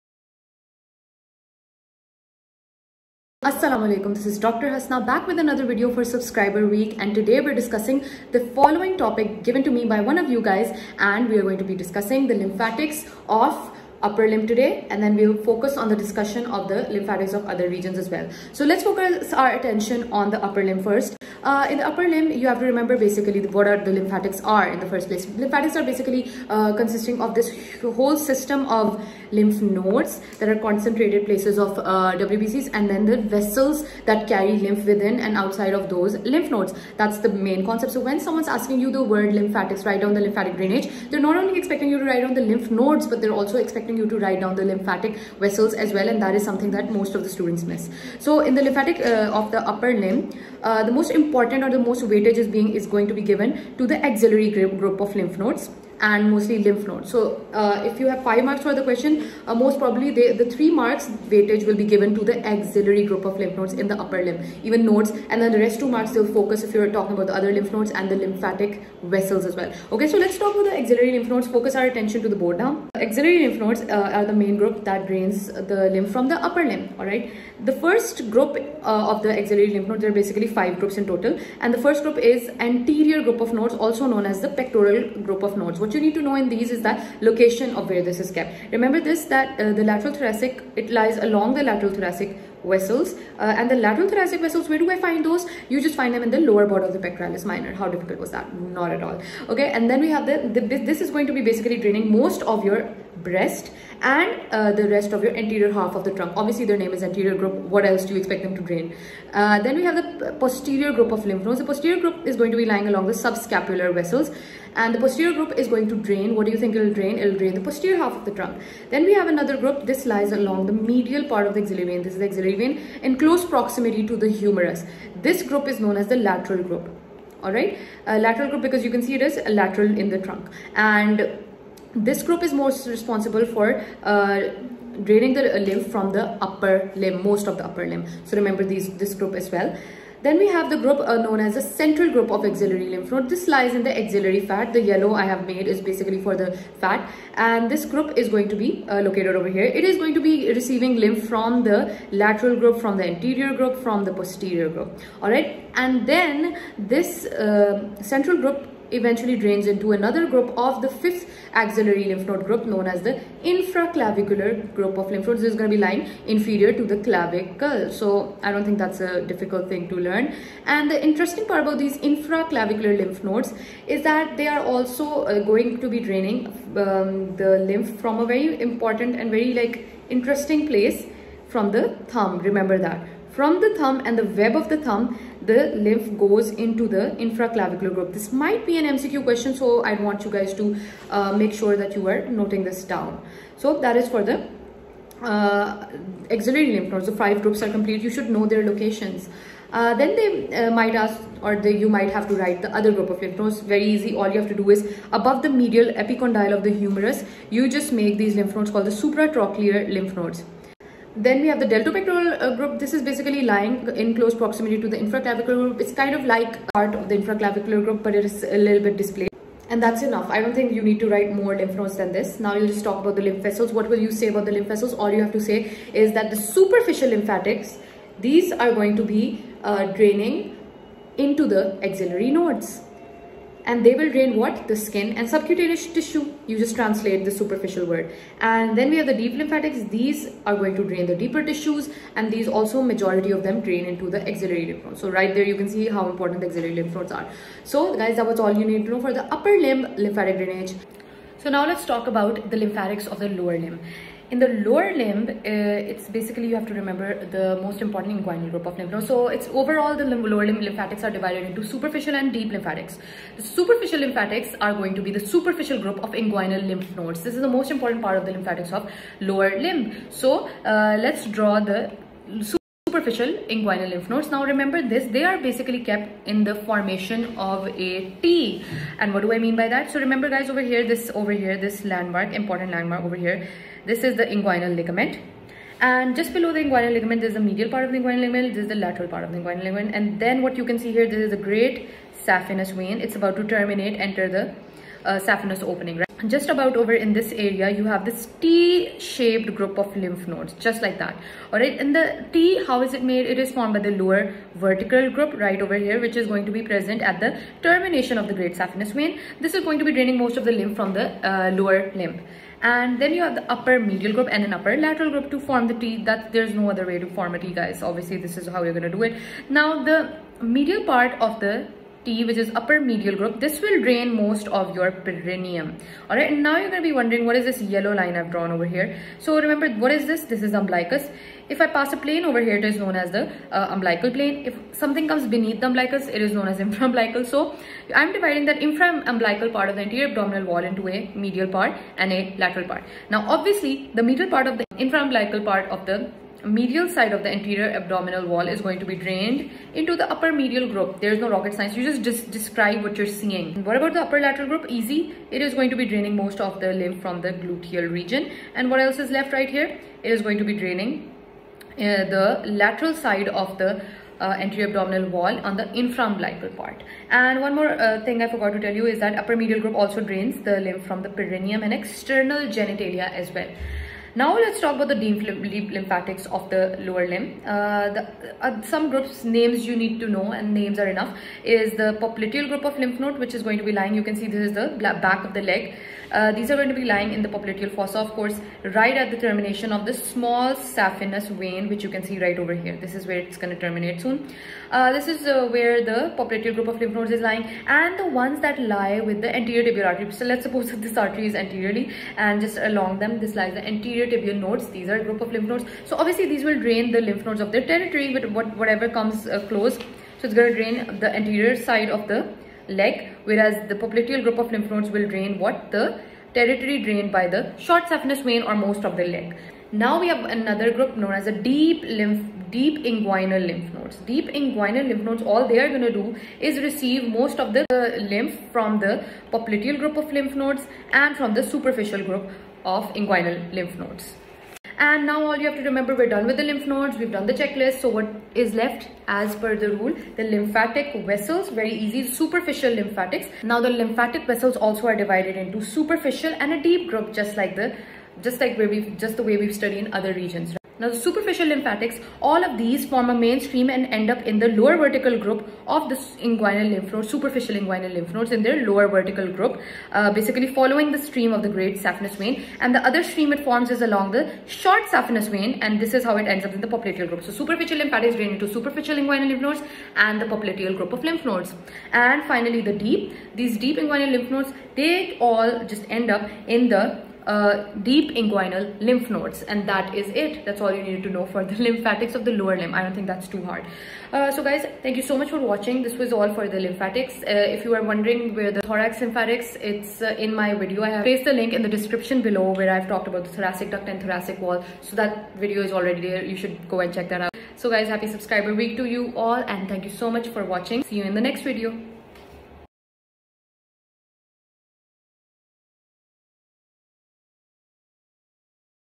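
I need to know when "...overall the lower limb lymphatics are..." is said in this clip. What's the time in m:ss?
4:19.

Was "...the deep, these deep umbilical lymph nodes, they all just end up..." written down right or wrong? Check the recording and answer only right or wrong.
wrong.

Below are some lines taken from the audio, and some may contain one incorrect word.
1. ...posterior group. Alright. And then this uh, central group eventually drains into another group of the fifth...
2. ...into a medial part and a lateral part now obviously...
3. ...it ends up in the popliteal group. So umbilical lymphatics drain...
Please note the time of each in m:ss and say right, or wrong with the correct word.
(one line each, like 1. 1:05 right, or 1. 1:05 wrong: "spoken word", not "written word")
1. 2:34 right
2. 5:40 right
3. 7:46 wrong: "superficial", not "umbilical".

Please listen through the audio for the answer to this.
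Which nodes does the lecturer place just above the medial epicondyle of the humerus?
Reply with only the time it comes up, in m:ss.
3:28.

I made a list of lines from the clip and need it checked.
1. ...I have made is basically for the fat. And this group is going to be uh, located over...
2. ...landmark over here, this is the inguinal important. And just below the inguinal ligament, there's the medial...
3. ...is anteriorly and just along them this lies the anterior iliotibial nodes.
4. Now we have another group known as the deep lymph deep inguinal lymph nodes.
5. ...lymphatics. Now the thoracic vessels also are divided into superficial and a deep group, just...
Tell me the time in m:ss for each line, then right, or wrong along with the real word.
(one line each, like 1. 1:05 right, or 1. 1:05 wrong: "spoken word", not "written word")
1. 2:25 right
2. 4:42 wrong: "ligament", not "important"
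3. 6:41 right
4. 6:59 right
5. 7:22 wrong: "lymphatic", not "thoracic".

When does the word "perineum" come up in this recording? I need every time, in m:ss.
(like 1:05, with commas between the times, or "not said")
5:25, 6:11.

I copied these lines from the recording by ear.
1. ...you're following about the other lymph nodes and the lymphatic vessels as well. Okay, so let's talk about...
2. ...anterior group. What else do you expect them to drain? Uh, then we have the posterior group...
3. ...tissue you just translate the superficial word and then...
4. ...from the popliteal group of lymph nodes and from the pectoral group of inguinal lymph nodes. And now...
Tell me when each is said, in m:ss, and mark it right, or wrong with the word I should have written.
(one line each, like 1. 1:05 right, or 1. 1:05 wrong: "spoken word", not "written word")
1. 1:06 wrong: "talking", not "following"
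2. 1:47 right
3. 3:55 right
4. 7:08 wrong: "superficial", not "pectoral".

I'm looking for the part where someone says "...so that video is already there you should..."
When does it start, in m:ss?
8:14.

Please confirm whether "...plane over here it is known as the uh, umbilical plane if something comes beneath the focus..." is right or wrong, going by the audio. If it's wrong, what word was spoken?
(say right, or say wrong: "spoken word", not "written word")
wrong: "umbilicus", not "focus".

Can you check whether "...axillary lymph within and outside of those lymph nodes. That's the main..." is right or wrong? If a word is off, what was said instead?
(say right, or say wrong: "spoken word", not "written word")
wrong: "carry", not "axillary".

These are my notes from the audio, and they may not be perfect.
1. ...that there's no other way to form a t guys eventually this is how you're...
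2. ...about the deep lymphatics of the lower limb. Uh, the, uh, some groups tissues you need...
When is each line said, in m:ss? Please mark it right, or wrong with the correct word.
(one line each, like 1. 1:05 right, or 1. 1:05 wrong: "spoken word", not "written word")
1. 5:16 wrong: "obviously", not "eventually"
2. 6:14 wrong: "names", not "tissues".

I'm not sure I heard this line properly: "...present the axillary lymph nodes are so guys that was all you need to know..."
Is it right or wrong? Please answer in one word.
wrong.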